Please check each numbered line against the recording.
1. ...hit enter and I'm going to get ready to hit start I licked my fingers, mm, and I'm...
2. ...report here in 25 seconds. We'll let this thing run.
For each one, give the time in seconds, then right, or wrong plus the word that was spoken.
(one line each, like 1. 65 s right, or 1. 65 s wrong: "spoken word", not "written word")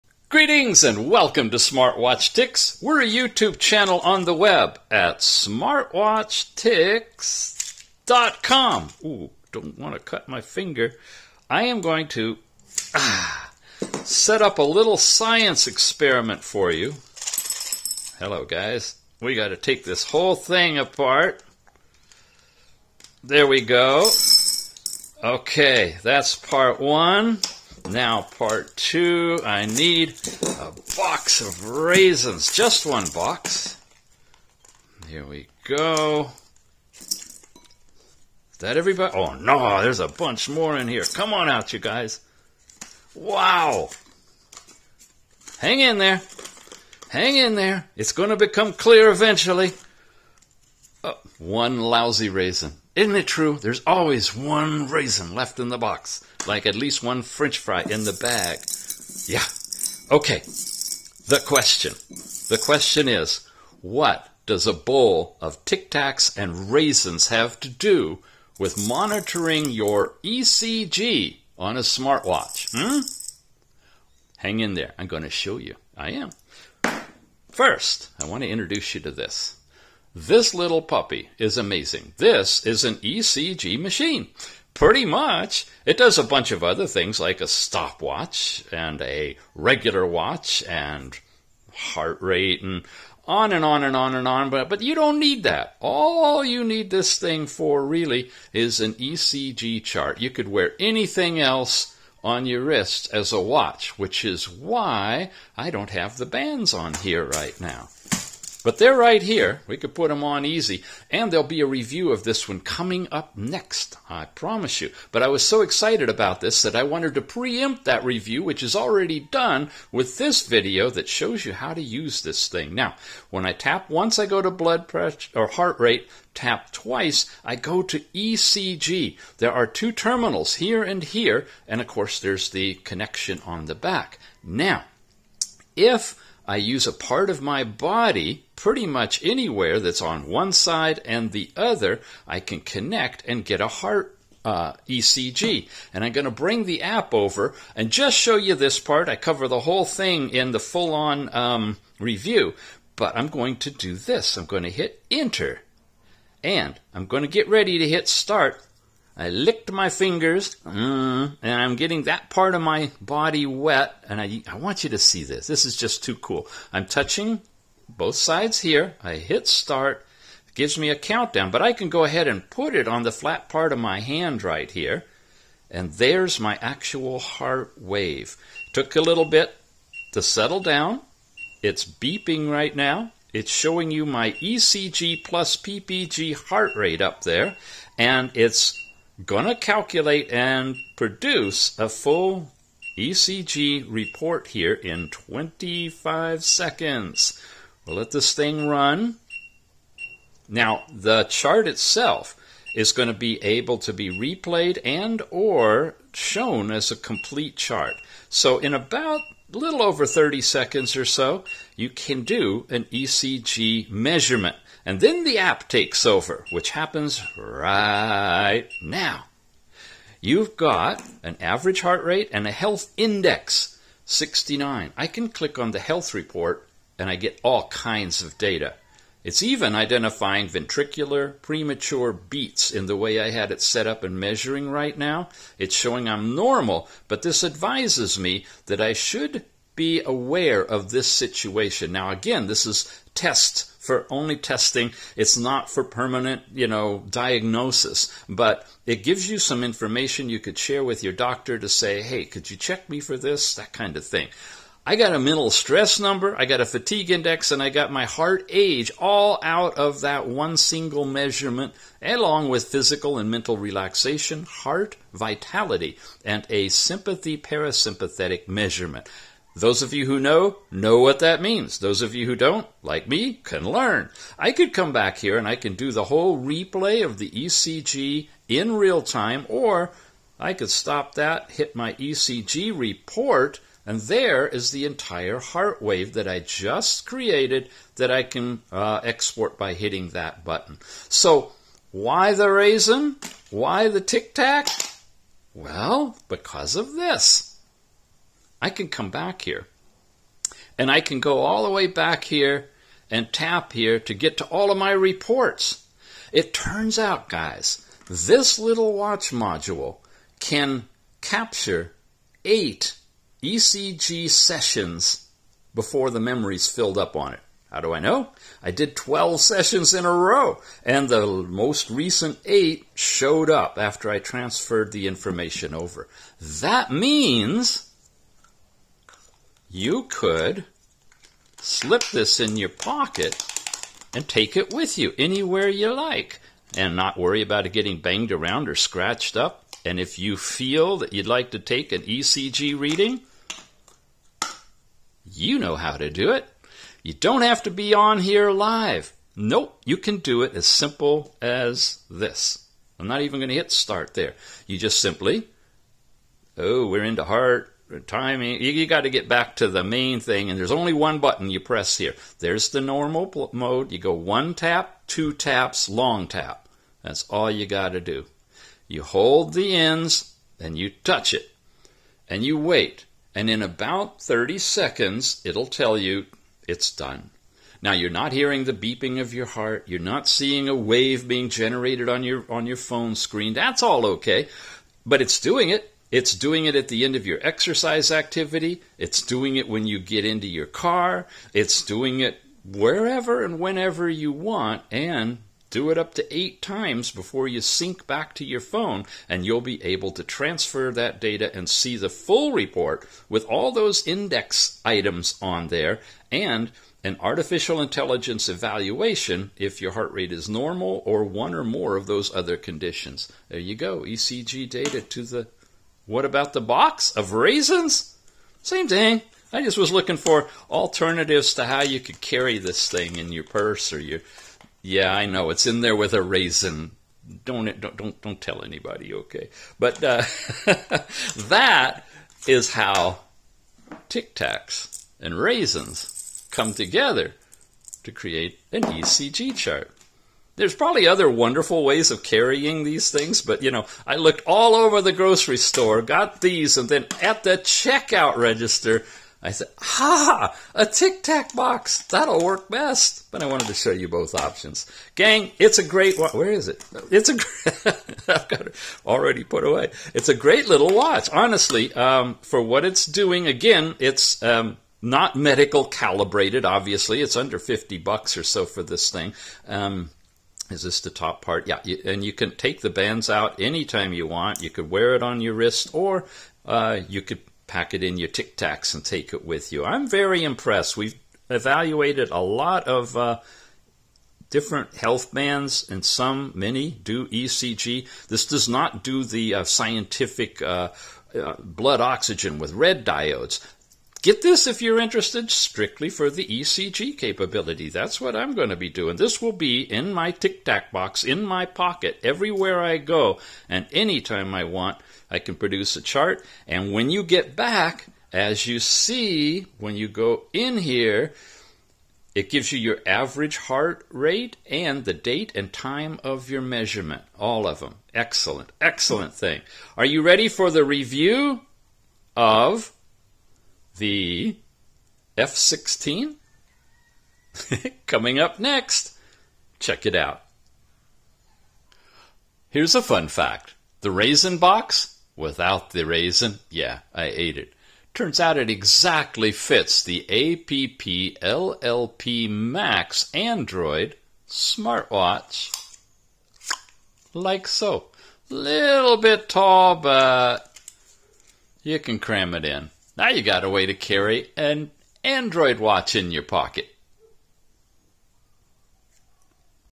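1. 154 s right
2. 193 s right.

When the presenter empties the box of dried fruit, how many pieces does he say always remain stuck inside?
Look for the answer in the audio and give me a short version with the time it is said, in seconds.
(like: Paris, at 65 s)
1, at 51 s.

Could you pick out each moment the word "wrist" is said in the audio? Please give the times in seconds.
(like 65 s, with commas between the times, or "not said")
102 s, 475 s.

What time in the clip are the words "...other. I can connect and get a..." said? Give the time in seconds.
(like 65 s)
141 s.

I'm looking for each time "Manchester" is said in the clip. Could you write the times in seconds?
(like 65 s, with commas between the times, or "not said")
not said.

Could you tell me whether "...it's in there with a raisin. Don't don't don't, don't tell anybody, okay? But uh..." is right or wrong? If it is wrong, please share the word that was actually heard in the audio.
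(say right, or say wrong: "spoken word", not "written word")
right.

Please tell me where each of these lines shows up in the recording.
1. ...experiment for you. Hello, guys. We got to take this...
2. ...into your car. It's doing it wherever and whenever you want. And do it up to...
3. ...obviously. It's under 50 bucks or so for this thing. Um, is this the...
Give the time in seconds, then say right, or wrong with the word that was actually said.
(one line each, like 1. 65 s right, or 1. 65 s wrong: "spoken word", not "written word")
1. 15 s right
2. 390 s right
3. 466 s right.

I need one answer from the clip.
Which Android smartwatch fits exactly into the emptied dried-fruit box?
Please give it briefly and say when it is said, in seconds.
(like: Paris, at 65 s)
APP LLP Max, at 540 s.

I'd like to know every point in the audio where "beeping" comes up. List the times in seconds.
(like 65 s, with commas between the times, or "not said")
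181 s, 378 s.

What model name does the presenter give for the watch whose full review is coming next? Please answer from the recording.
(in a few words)
F 16.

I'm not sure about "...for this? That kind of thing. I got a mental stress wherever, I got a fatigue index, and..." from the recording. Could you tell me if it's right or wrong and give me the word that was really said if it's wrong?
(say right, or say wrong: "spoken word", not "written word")
wrong: "number", not "wherever".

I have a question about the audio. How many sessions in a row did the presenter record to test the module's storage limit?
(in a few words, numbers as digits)
12.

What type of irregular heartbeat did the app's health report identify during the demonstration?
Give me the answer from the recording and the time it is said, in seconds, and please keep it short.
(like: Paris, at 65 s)
Ventricular premature beats, at 230 s.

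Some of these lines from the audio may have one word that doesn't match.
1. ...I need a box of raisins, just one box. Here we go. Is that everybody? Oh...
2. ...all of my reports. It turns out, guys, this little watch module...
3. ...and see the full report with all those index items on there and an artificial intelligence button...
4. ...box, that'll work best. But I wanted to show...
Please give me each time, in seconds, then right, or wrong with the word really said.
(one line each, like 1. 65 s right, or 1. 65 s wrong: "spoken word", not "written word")
1. 29 s right
2. 304 s right
3. 401 s wrong: "evaluation", not "button"
4. 451 s right.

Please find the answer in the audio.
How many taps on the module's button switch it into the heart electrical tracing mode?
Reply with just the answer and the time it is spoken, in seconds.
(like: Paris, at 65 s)
2, at 126 s.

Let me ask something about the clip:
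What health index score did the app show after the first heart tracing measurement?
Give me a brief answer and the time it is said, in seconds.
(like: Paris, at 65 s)
69, at 224 s.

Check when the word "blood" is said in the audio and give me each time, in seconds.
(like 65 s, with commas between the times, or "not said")
124 s, 491 s.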